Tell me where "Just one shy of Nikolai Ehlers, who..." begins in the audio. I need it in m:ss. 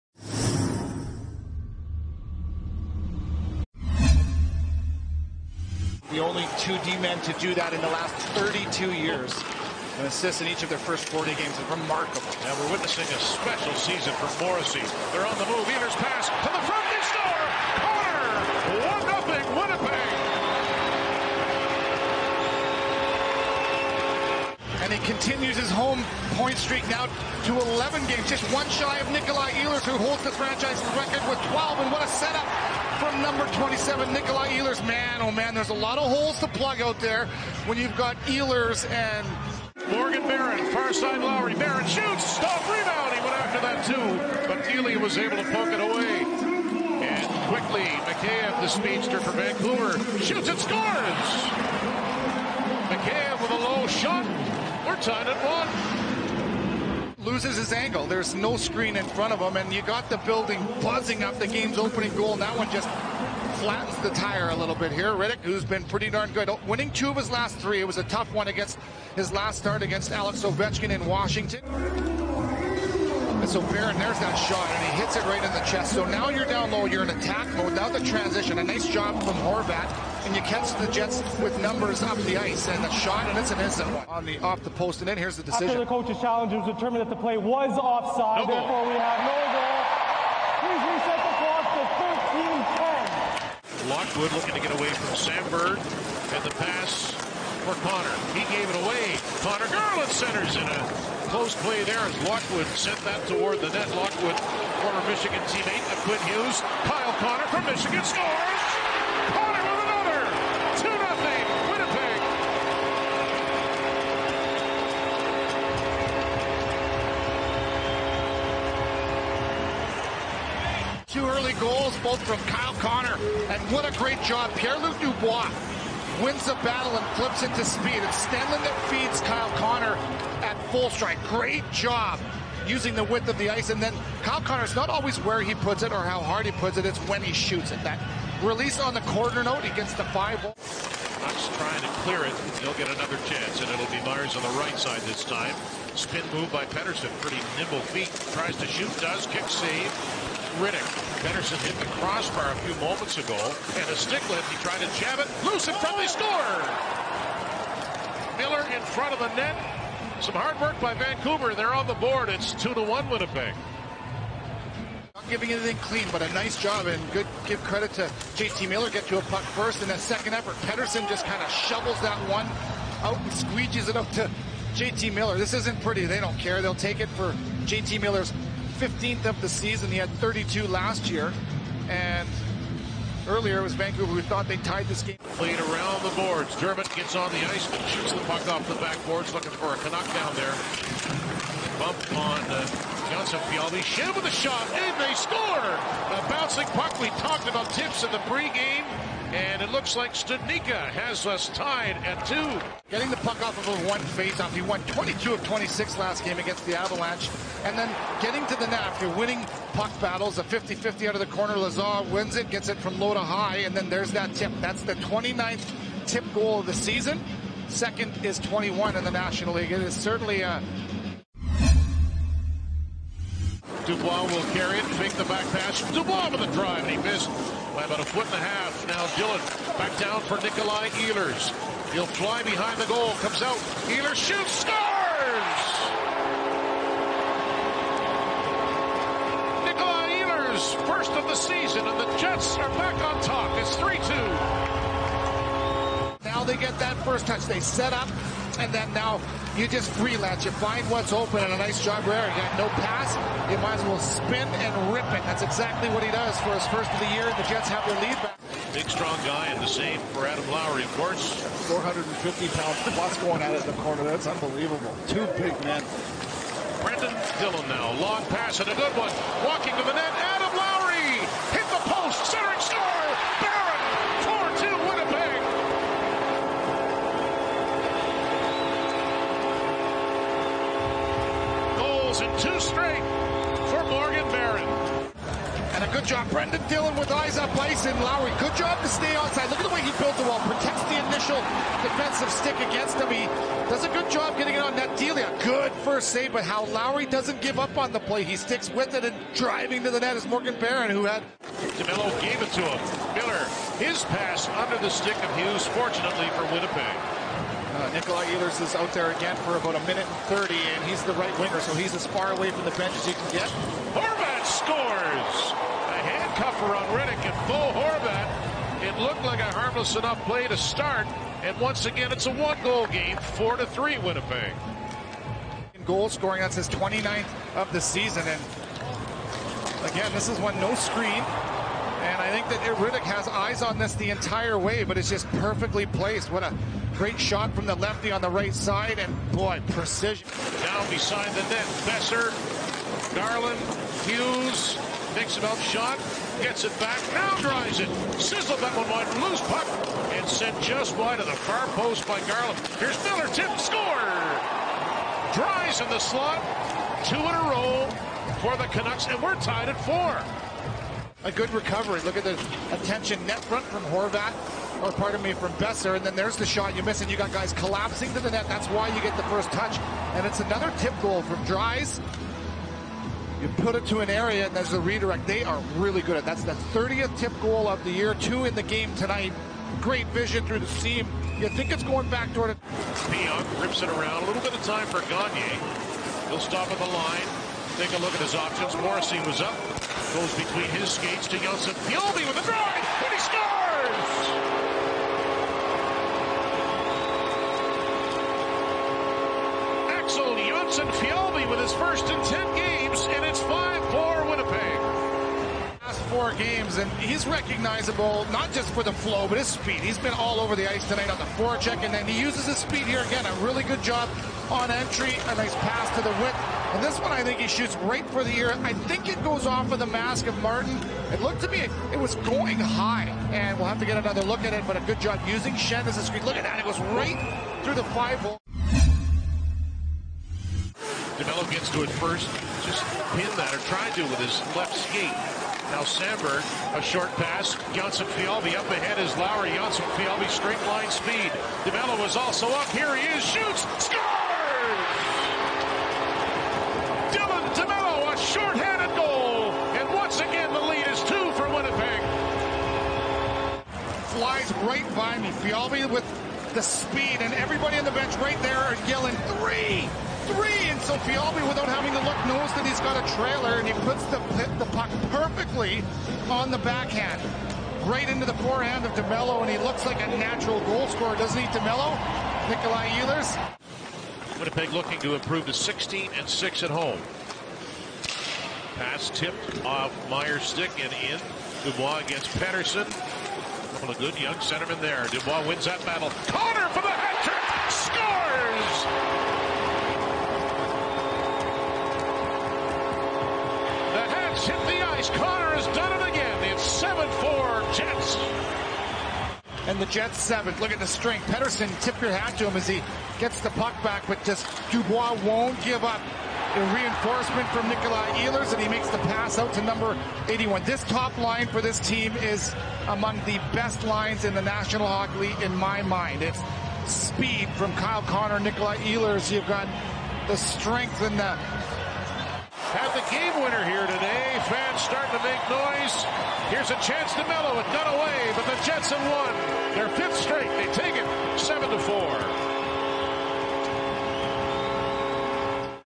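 0:28.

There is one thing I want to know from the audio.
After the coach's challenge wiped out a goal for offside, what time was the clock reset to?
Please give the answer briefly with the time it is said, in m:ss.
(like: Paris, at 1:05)
13:10, at 1:33.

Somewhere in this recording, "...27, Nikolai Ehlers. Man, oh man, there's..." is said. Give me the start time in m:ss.
0:33.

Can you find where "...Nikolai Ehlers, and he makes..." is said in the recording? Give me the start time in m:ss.
8:27.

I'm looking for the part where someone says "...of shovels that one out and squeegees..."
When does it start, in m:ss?
2:51.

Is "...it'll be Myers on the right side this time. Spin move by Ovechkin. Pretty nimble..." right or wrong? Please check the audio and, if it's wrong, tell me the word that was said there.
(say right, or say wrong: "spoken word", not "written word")
wrong: "Pettersson", not "Ovechkin".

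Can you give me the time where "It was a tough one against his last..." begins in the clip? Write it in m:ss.
1:07.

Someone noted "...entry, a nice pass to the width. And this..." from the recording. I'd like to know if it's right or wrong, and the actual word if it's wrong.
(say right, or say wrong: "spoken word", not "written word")
right.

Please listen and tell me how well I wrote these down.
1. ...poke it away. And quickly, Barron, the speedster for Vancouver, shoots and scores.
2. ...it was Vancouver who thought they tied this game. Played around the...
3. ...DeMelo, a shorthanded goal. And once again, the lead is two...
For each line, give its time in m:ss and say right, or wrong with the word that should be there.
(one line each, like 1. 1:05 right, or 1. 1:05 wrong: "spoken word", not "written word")
1. 0:45 wrong: "Mikheyev", not "Barron"
2. 3:03 right
3. 7:27 right.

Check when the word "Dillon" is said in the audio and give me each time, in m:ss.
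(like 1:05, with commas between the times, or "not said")
3:49, 4:27, 4:46.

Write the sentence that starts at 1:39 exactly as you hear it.
Conor Garland centers in a close play there as Lockwood sent that toward the net.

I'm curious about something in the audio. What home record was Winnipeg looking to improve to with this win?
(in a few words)
16 and 6.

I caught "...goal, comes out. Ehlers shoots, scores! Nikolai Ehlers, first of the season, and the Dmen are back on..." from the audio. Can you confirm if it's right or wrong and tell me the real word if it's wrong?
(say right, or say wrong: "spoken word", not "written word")
wrong: "Jets", not "Dmen".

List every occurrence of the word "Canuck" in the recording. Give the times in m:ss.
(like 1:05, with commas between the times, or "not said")
3:09, 5:58.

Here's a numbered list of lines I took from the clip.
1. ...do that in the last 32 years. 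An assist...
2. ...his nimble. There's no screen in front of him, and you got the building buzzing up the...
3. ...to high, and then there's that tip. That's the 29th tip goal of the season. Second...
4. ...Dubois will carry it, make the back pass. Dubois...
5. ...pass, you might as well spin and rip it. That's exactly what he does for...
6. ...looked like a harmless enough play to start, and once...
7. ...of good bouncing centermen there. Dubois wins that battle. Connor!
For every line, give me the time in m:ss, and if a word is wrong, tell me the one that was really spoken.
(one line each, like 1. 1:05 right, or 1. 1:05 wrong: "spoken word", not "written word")
1. 0:07 right
2. 0:57 wrong: "angle", not "nimble"
3. 3:33 right
4. 3:43 right
5. 4:12 right
6. 5:18 right
7. 8:03 wrong: "young", not "bouncing".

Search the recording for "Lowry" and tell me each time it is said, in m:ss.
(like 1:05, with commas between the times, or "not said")
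0:41, 4:20, 4:48, 4:56, 7:19.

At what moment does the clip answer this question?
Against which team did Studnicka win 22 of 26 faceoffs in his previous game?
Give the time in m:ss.
3:26.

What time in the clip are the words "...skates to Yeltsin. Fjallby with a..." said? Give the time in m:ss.
6:30.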